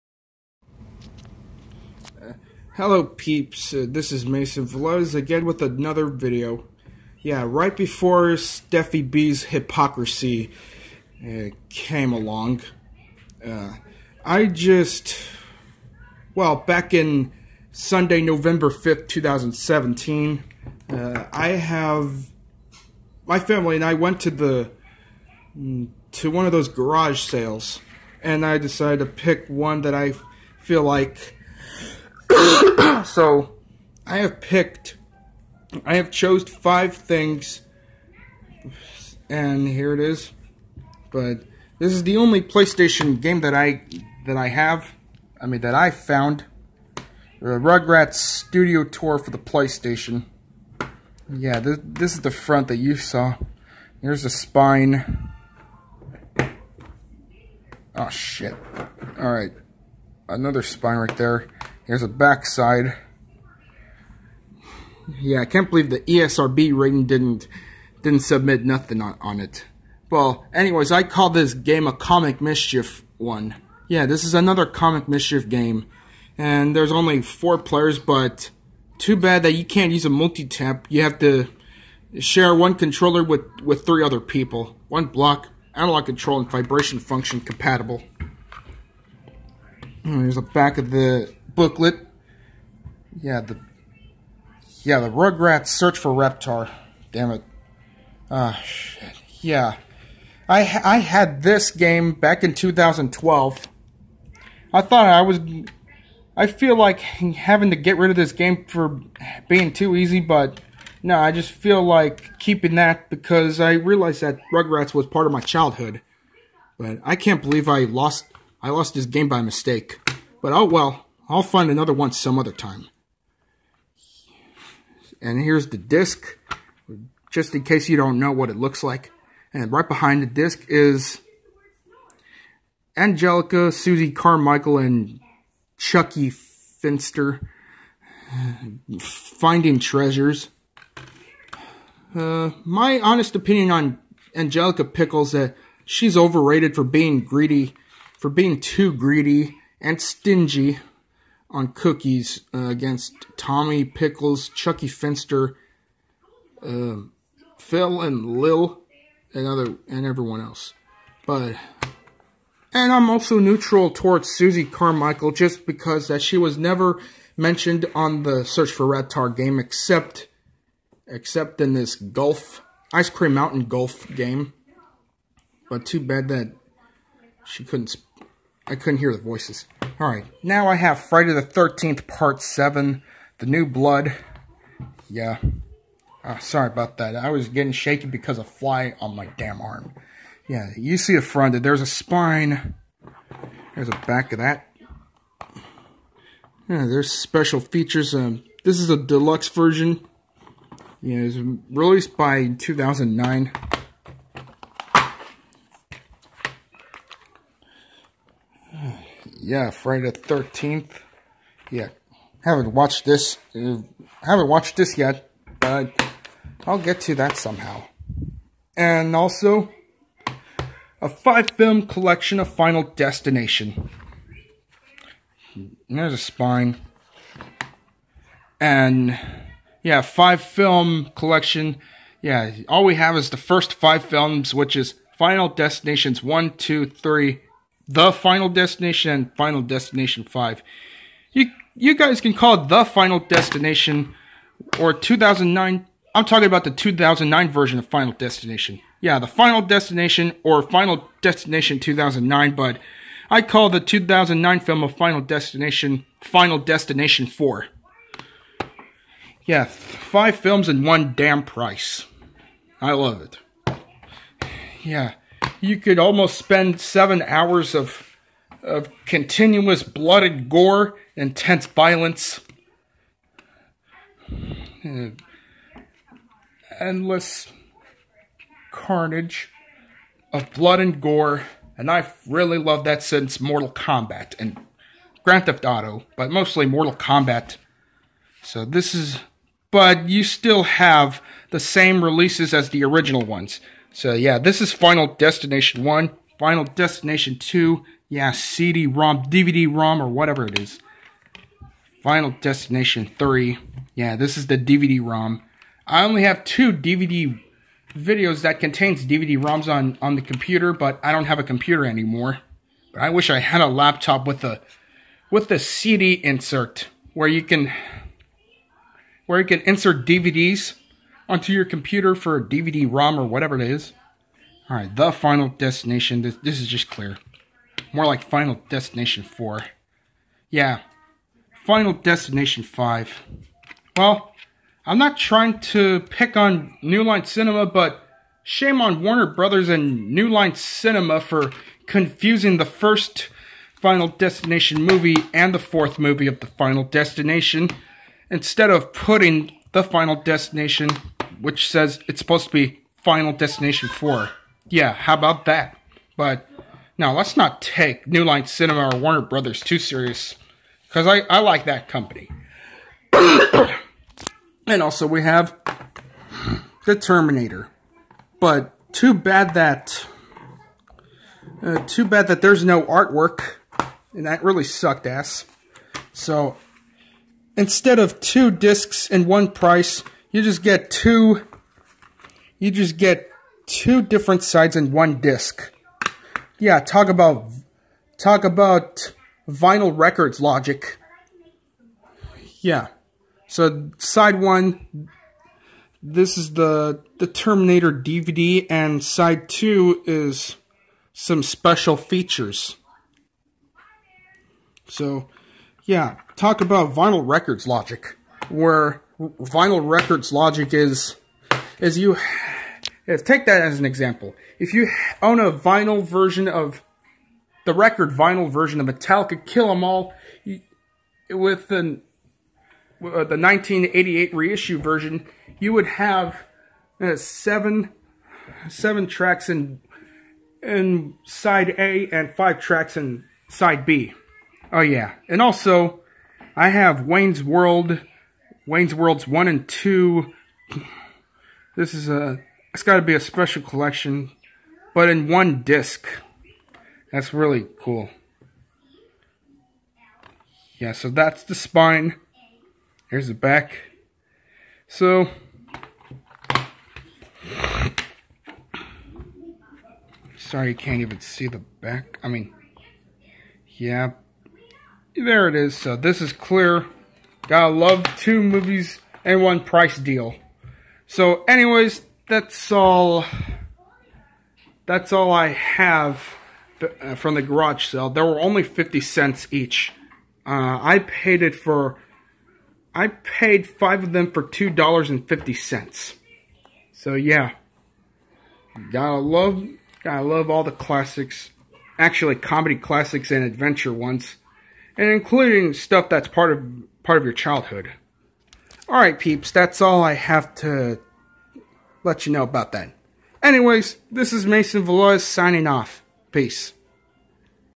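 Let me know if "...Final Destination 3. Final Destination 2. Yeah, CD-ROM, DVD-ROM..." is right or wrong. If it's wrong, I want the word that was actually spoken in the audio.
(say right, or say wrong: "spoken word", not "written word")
wrong: "1", not "3".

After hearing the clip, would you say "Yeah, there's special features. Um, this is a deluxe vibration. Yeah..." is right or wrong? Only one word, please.
wrong.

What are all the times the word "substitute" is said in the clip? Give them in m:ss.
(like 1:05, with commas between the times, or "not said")
not said.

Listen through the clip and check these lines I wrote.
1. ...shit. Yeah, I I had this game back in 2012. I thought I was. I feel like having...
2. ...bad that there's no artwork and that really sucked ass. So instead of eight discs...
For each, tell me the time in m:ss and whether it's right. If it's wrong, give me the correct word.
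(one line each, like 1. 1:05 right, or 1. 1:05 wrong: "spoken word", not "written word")
1. 1:38 right
2. 6:12 wrong: "two", not "eight".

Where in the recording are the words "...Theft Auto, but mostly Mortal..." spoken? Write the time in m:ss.
4:45.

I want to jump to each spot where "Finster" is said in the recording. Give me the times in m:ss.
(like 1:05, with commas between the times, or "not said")
2:16, 2:34.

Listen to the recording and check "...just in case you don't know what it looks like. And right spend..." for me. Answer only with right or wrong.
wrong.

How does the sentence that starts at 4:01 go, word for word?
You you guys can call it The Final Destination or 2009 I'm talking about the 2009 version of Final Destination.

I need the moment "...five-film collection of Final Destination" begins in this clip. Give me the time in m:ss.
3:41.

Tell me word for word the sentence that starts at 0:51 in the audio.
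Yeah, this, this is the front that you saw.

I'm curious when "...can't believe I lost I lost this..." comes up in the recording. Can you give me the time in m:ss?
1:57.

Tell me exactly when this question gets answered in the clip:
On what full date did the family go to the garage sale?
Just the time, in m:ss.
0:17.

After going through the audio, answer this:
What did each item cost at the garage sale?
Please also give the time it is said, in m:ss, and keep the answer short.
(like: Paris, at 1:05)
50 cents, at 7:58.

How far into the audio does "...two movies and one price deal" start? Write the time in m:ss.
7:48.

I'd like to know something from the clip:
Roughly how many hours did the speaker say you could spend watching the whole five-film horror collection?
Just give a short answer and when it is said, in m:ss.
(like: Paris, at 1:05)
7, at 4:26.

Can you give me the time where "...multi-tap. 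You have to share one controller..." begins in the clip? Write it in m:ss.
1:20.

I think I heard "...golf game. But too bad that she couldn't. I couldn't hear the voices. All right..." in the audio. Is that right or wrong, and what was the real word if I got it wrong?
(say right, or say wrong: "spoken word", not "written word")
right.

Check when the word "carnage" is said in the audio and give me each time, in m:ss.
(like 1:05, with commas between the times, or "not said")
4:38.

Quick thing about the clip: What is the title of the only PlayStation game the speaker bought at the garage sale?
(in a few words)
Rugrats Studio Tour.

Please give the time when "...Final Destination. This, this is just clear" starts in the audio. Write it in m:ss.
5:25.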